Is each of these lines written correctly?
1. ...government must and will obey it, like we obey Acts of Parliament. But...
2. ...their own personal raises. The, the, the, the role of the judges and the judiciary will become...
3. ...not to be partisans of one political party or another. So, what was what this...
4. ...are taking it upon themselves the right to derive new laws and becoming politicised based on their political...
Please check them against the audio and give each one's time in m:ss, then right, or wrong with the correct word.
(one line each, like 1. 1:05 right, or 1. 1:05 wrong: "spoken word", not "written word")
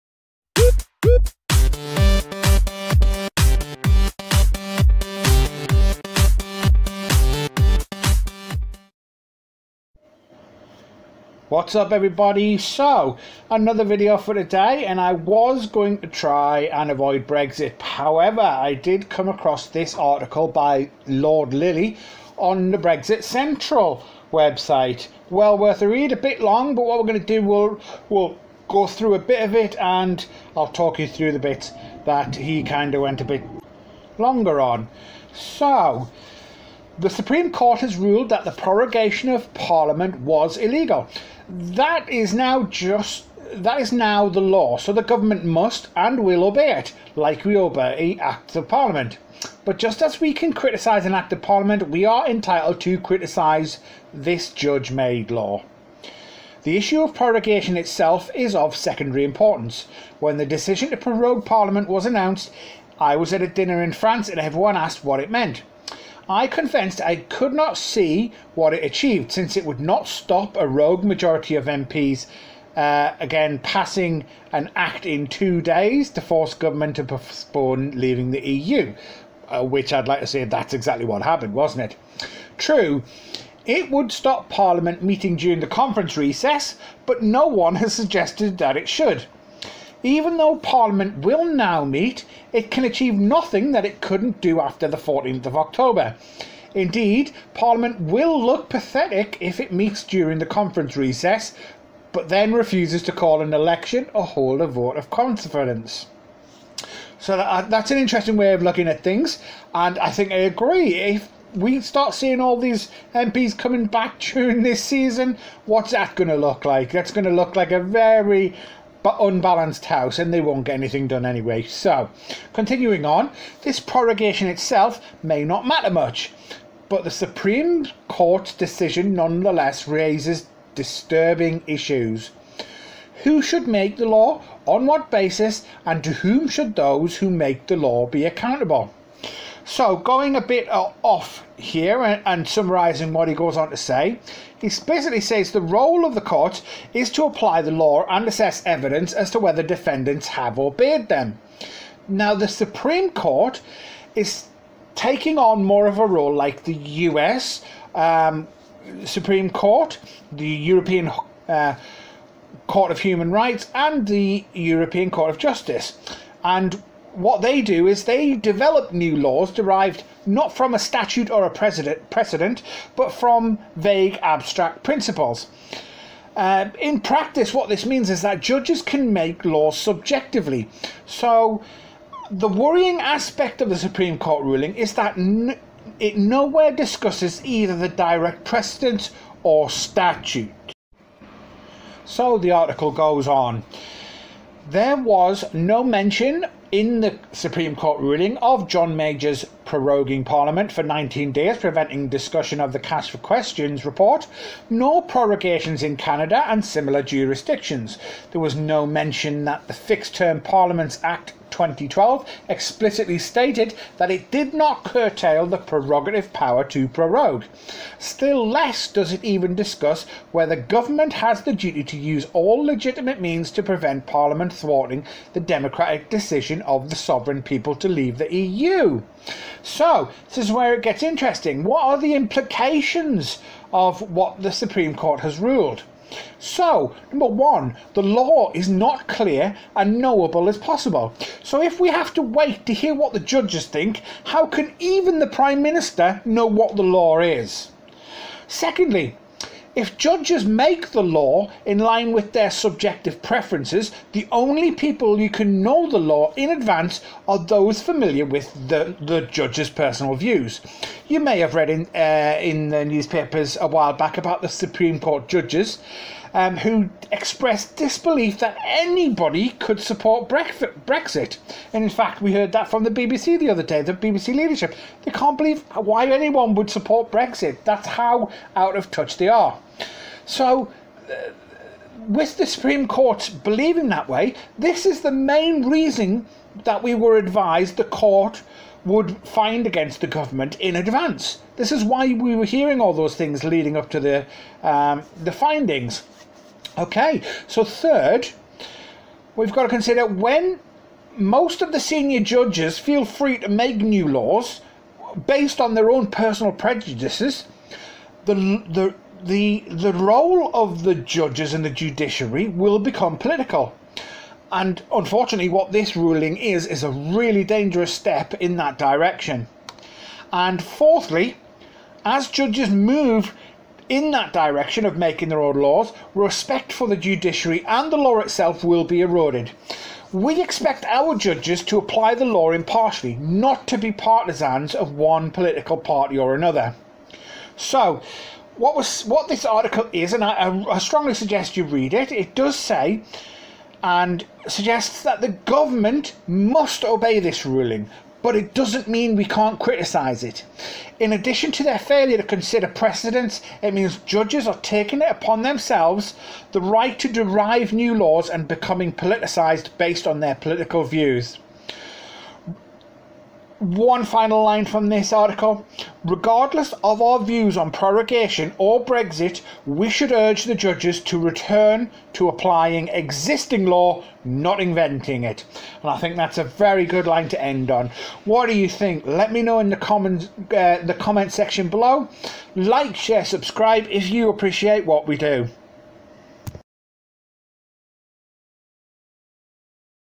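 1. 0:45 right
2. 5:05 wrong: "prejudices", not "raises"
3. 5:33 right
4. 5:54 right.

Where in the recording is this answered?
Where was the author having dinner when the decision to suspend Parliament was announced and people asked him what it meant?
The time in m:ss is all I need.
1:03.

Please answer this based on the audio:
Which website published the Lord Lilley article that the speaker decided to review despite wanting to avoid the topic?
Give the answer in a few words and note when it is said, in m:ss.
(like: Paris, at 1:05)
Brexit Central, at 0:22.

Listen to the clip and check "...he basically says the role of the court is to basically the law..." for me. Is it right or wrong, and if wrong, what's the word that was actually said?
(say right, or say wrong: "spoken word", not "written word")
wrong: "apply", not "basically".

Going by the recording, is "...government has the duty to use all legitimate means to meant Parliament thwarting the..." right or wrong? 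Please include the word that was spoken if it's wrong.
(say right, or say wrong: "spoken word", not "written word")
wrong: "prevent", not "meant".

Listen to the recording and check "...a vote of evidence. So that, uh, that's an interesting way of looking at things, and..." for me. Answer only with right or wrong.
wrong.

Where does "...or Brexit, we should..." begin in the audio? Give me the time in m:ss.
6:08.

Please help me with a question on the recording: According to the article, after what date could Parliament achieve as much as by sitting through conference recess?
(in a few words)
14th of October.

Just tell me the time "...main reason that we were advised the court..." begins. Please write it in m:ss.
4:45.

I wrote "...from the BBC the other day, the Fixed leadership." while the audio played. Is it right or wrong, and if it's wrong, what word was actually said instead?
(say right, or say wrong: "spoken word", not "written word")
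wrong: "BBC", not "Fixed".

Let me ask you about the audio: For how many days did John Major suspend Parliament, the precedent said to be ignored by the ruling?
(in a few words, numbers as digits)
19.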